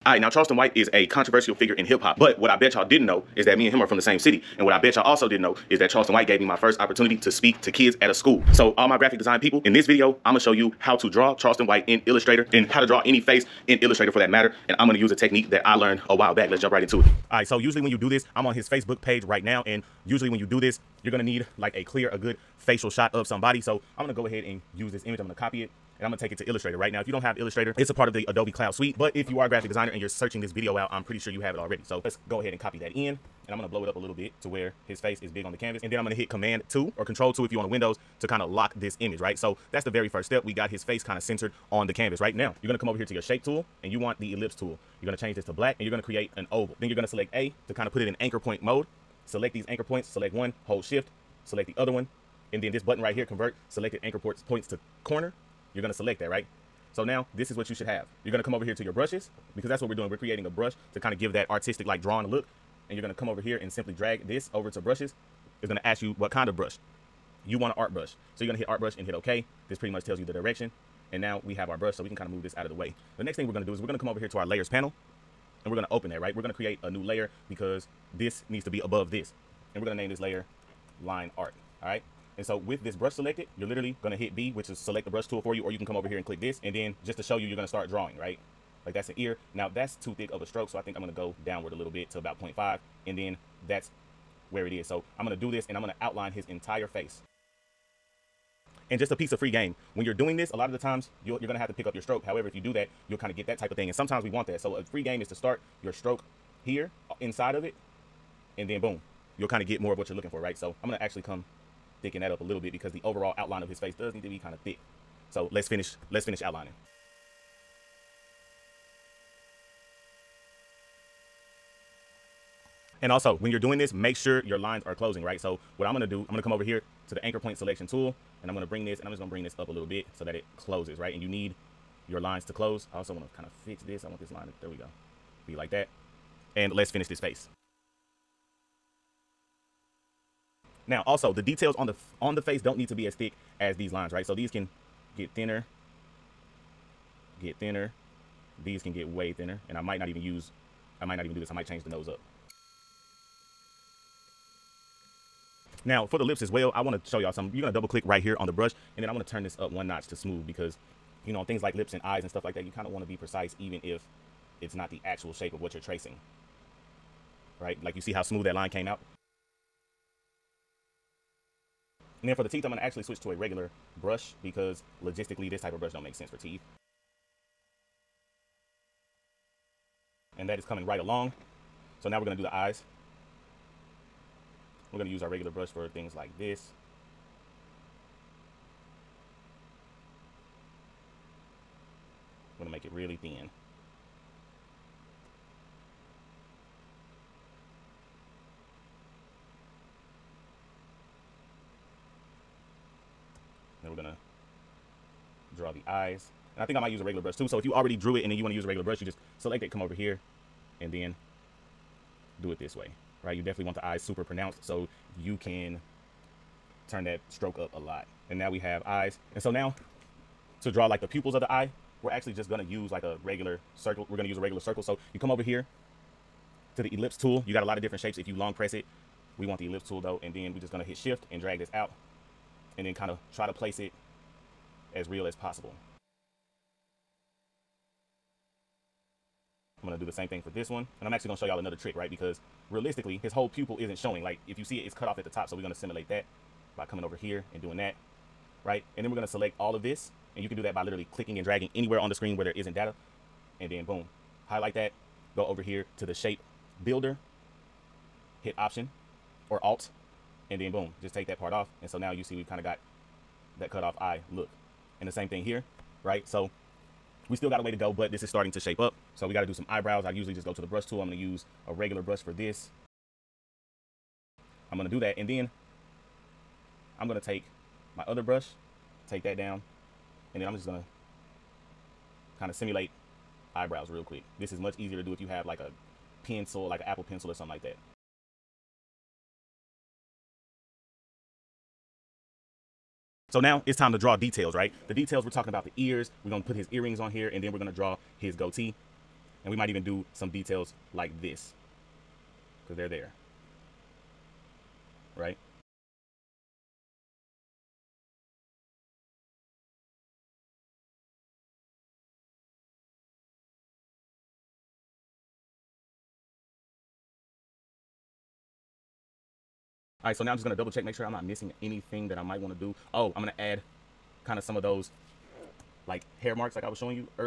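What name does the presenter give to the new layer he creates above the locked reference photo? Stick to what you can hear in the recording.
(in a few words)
line art.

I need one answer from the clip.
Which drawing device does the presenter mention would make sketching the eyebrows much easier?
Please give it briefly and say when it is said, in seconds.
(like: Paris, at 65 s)
Apple pencil, at 286 s.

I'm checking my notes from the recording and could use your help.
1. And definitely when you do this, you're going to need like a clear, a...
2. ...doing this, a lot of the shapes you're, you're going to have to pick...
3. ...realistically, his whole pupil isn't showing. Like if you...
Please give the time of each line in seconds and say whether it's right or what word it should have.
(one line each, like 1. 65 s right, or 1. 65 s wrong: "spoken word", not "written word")
1. 19 s wrong: "usually", not "definitely"
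2. 100 s wrong: "times", not "shapes"
3. 242 s right.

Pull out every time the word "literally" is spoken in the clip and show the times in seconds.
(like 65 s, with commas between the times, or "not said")
83 s, 250 s.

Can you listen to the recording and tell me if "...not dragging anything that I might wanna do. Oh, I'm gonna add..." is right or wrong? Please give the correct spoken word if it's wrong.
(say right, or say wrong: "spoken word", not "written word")
wrong: "missing", not "dragging".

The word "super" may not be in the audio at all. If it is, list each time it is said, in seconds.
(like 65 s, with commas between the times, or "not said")
213 s.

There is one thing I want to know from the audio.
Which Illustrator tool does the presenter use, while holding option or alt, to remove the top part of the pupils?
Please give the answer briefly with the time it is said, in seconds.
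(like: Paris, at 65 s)
Shape builder, at 256 s.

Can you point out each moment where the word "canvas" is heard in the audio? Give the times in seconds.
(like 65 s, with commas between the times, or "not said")
35 s, 41 s.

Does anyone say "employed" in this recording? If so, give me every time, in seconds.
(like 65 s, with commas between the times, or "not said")
not said.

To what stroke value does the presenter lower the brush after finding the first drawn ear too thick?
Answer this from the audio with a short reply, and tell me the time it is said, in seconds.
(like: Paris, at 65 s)
0.5, at 92 s.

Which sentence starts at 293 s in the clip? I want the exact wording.
So now it's time to draw details, right?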